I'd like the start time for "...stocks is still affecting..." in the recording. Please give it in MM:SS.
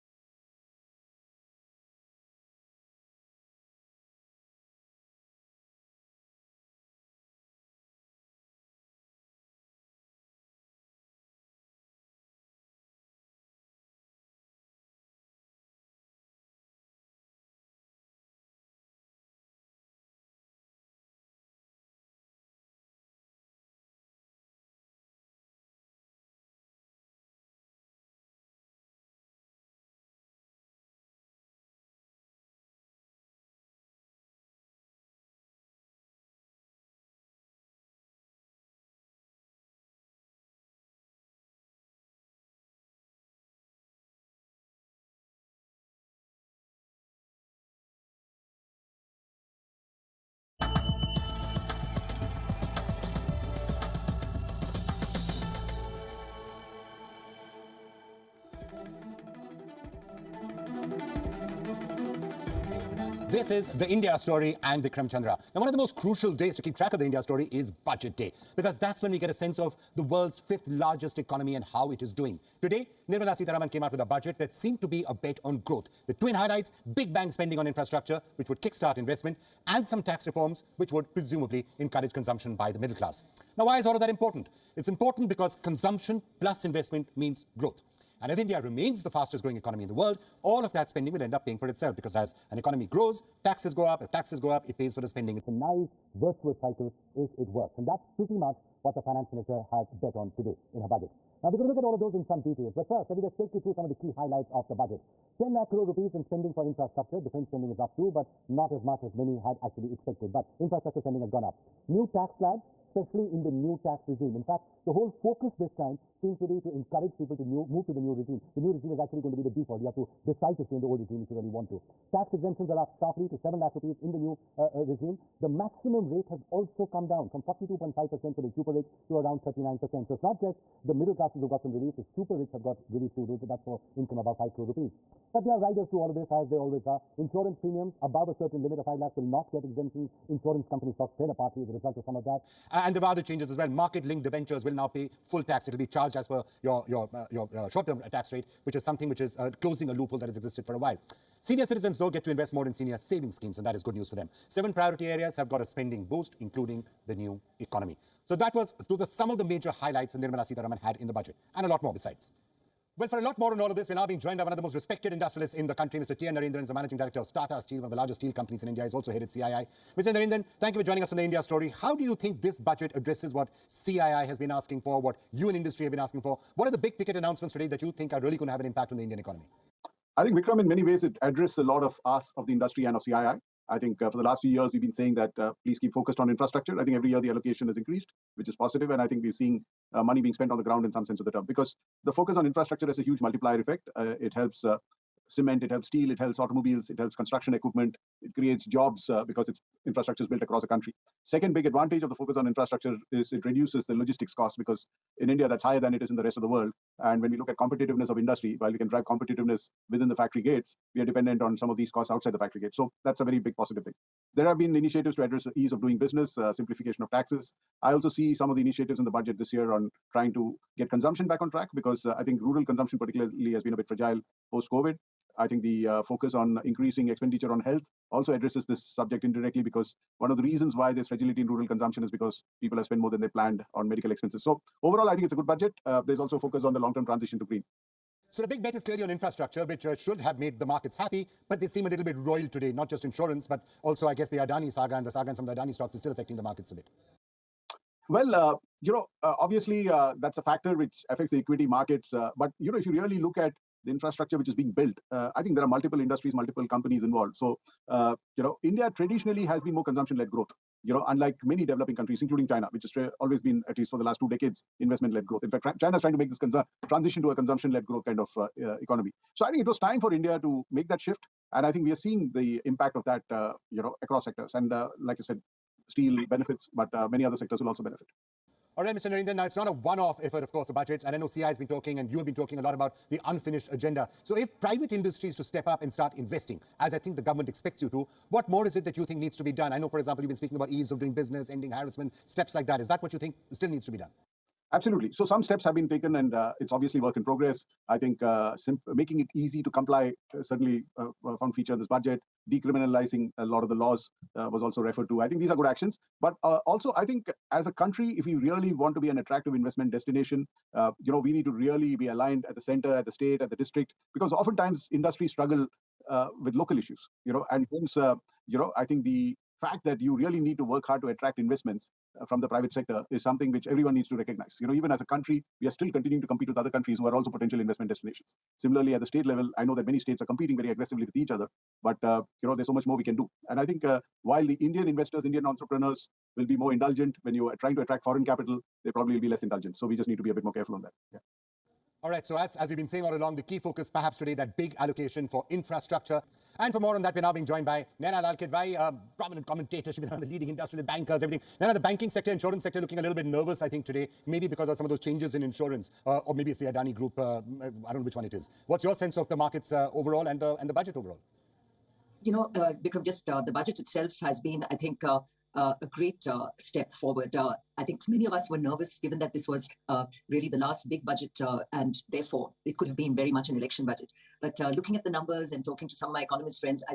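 04:05.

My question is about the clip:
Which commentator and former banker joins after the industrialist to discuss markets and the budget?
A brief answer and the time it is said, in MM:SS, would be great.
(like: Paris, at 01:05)
Naina Lal Kidwai, at 05:47.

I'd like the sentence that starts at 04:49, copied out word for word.
I know, for example, you've been speaking about ease of doing business, ending harassment, steps like that.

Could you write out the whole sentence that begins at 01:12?
Today, Nirmala Sitharaman came out with a budget that seemed to be a bet on growth.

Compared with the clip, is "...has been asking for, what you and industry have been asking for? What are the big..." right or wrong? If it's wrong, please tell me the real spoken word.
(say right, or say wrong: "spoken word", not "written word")
right.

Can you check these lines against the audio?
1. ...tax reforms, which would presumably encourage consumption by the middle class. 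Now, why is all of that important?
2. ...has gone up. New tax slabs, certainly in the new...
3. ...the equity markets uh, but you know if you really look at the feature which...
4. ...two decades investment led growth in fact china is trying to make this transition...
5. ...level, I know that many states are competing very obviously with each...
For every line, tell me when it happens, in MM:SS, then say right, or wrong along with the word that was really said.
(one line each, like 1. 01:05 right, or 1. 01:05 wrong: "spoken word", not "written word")
1. 01:20 right
2. 01:51 wrong: "especially", not "certainly"
3. 04:11 wrong: "infrastructure", not "feature"
4. 04:24 right
5. 05:29 wrong: "aggressively", not "obviously".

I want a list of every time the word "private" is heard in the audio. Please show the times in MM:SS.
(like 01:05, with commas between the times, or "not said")
04:44, 05:22.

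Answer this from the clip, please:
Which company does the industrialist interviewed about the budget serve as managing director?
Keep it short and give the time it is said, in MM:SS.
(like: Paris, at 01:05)
Tata Steel, at 02:47.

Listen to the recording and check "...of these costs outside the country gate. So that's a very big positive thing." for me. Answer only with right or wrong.
wrong.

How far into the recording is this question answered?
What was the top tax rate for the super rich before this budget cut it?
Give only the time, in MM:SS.
02:07.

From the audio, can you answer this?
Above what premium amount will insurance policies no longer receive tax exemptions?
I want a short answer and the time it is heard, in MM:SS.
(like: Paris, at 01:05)
5 lakhs, at 02:18.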